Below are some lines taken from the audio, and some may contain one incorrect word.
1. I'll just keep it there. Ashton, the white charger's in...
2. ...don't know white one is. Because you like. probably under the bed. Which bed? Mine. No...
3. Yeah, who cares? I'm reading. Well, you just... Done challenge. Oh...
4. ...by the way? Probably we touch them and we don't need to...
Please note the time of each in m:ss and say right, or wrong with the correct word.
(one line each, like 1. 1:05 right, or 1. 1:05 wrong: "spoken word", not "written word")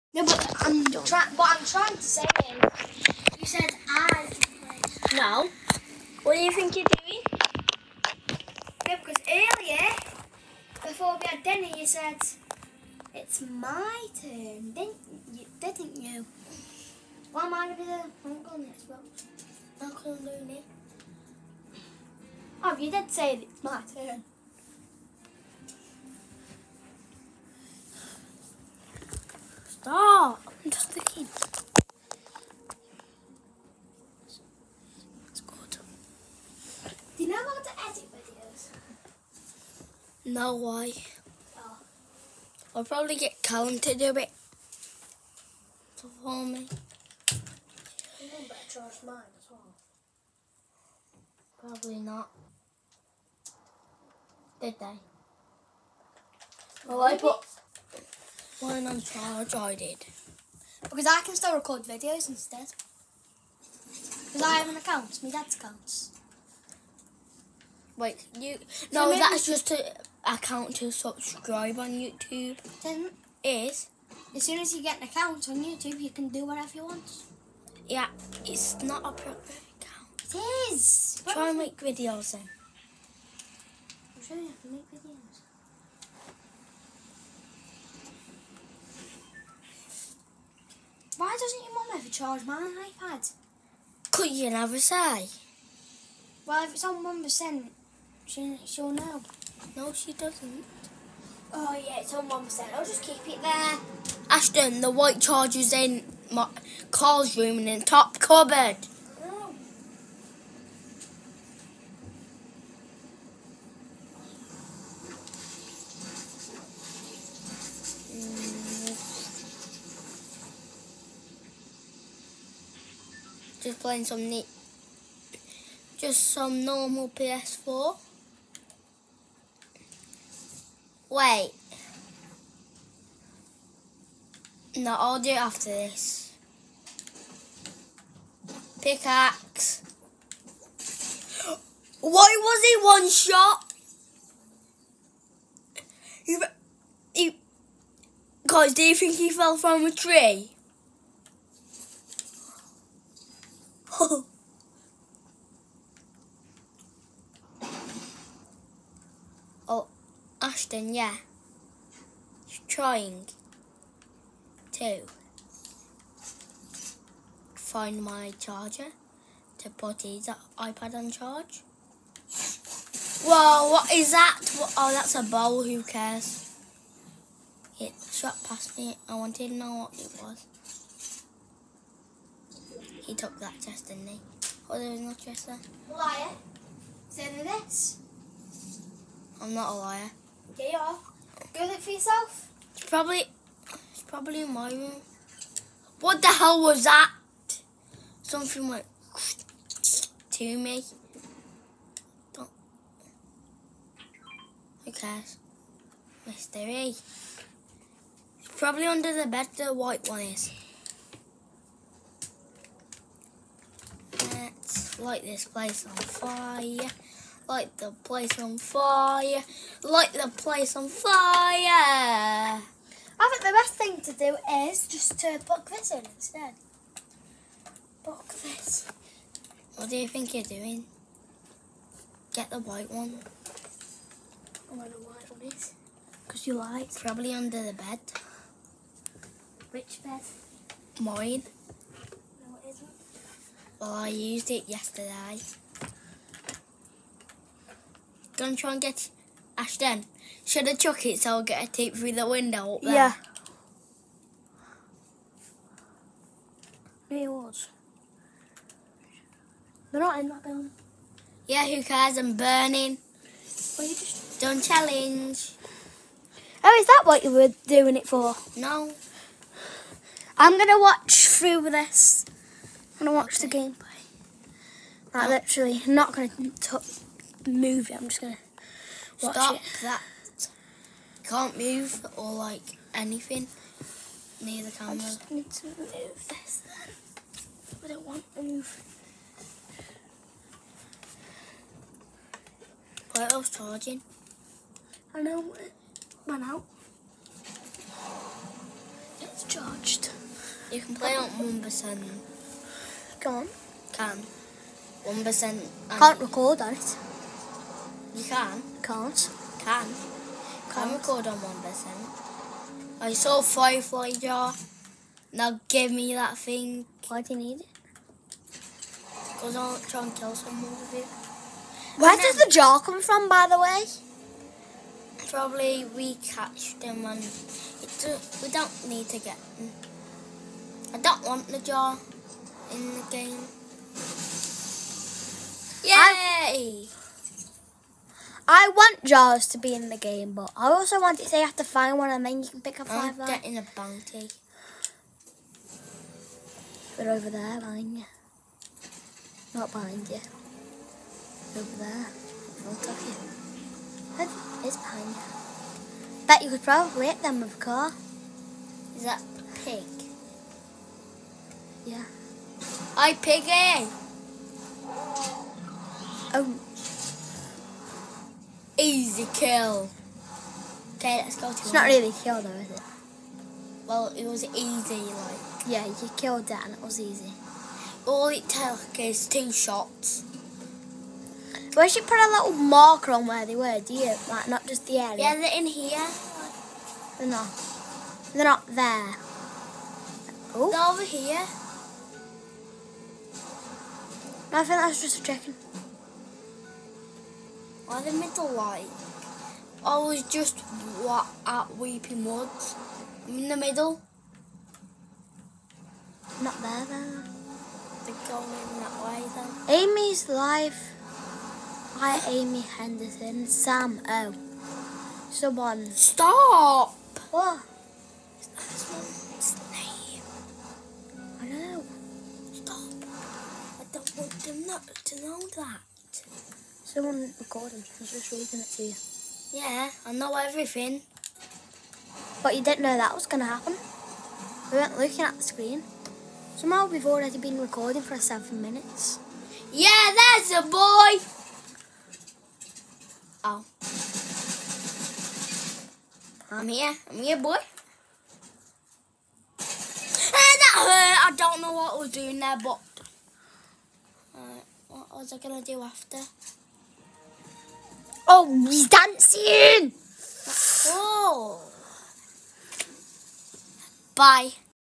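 1. 1:42 right
2. 3:54 right
3. 4:21 wrong: "burning", not "reading"
4. 5:23 wrong: "catch", not "touch".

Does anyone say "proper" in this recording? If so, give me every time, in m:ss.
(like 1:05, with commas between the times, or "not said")
1:19.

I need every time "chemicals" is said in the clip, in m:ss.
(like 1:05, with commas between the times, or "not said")
not said.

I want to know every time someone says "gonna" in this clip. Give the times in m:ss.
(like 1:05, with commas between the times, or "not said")
0:17, 4:08, 4:38, 7:35.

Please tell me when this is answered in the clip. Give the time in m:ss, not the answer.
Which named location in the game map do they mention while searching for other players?
6:41.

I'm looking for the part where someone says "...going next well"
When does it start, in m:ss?
0:18.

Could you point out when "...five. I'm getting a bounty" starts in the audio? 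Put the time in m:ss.
5:42.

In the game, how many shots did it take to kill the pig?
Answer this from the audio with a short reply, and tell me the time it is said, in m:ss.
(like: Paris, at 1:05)
2, at 6:19.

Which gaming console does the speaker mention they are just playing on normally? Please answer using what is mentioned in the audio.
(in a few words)
PS4.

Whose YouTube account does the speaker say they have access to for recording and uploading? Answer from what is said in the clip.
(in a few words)
My dad's.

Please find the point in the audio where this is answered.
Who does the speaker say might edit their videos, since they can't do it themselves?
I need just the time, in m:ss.
0:43.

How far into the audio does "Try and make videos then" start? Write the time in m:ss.
1:21.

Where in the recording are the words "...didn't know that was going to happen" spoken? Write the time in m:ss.
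7:12.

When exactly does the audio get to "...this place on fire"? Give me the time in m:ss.
3:35.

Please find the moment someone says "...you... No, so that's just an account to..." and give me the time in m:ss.
1:08.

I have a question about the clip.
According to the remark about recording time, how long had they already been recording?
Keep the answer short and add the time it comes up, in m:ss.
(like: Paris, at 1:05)
7 minutes, at 7:18.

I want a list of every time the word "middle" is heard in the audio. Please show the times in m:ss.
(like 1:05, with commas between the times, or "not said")
6:38, 6:43.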